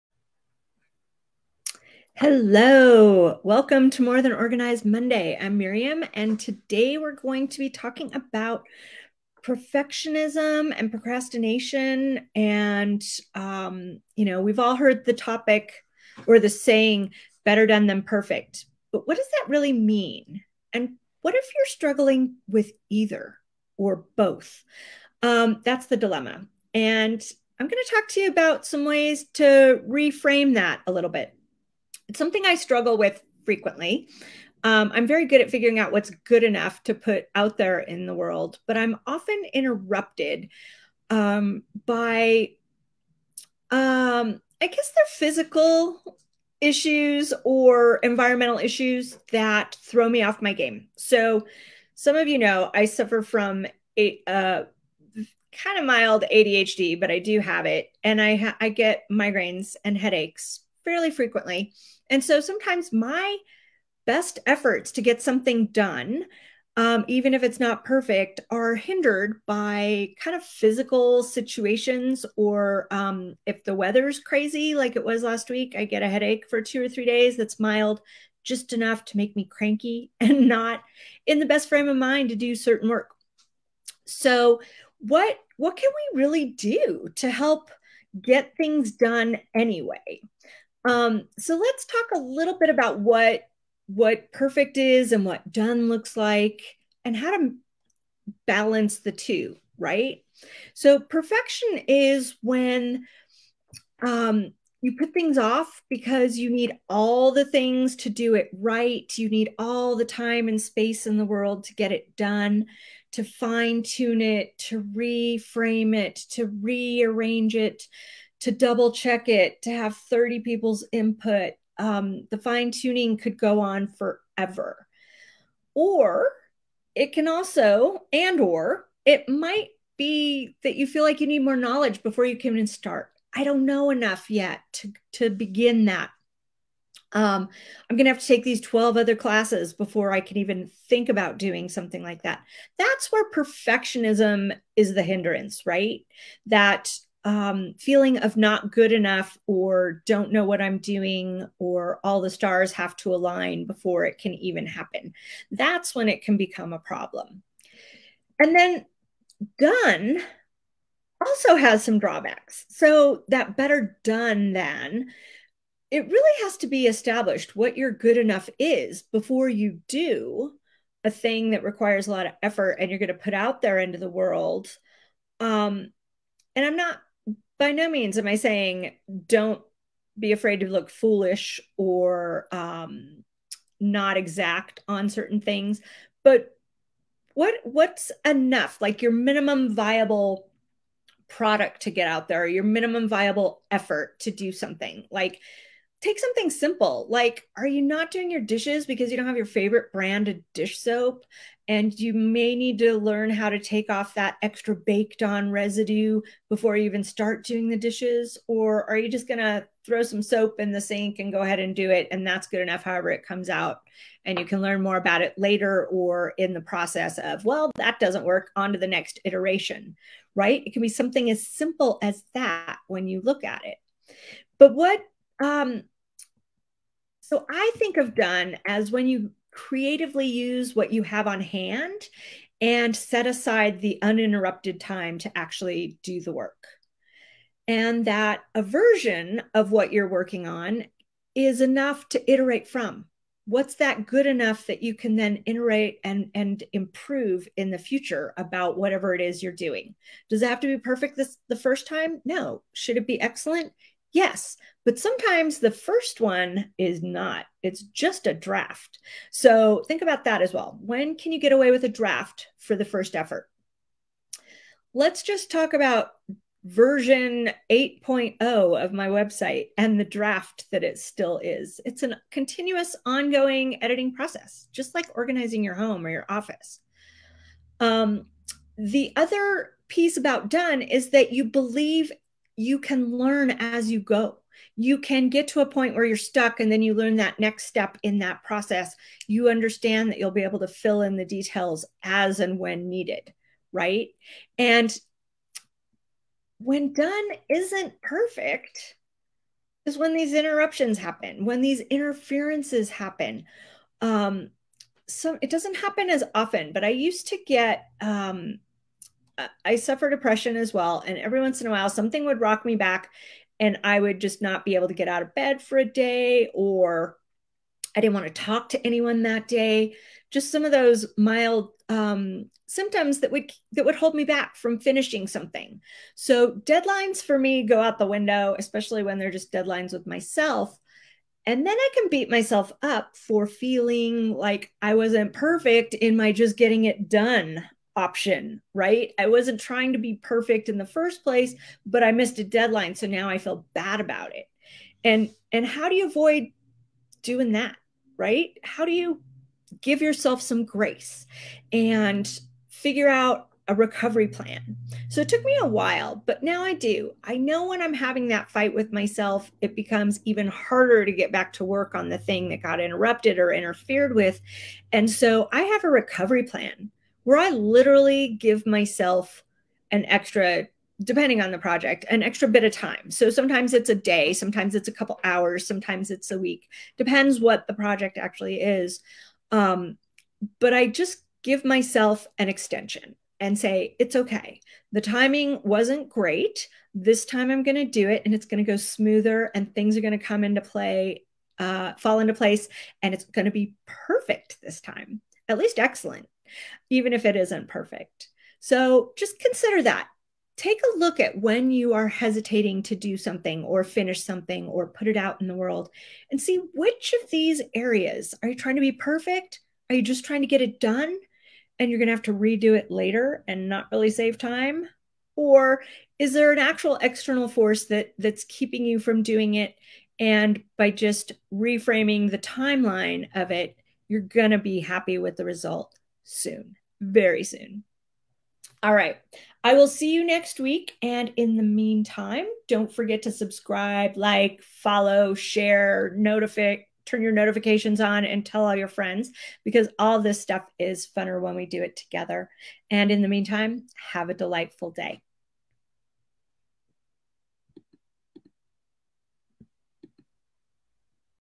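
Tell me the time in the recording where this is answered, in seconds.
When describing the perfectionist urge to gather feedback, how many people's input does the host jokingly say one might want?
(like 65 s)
119 s.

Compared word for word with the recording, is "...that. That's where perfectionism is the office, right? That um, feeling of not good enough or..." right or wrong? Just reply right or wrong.
wrong.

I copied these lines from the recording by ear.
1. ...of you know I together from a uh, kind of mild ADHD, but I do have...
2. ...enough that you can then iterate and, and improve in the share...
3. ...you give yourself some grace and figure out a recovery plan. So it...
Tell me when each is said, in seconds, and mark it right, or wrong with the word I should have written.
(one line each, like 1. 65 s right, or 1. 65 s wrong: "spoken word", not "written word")
1. 52 s wrong: "suffer", not "together"
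2. 244 s wrong: "future", not "share"
3. 348 s right.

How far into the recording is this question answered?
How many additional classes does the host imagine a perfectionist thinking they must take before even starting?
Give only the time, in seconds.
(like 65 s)
138 s.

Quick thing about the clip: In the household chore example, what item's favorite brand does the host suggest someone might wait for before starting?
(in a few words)
dish soap.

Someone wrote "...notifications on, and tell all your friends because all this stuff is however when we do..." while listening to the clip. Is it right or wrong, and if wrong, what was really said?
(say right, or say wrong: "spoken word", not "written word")
wrong: "funner", not "however".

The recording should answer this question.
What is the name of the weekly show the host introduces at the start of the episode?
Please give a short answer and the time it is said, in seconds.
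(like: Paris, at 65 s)
More Than Organized Monday, at 4 s.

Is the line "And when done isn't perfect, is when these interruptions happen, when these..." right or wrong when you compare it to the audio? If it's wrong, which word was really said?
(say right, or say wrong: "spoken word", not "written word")
right.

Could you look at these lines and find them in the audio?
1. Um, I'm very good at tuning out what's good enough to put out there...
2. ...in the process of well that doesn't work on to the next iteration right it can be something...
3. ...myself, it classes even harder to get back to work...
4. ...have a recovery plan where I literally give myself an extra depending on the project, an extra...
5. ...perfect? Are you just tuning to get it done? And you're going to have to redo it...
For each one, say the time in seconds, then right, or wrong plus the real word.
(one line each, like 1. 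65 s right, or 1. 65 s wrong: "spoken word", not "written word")
1. 34 s wrong: "figuring", not "tuning"
2. 216 s right
3. 358 s wrong: "becomes", not "classes"
4. 365 s right
5. 408 s wrong: "trying", not "tuning".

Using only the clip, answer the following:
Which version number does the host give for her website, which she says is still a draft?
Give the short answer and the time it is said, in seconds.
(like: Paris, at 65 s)
8.0, at 267 s.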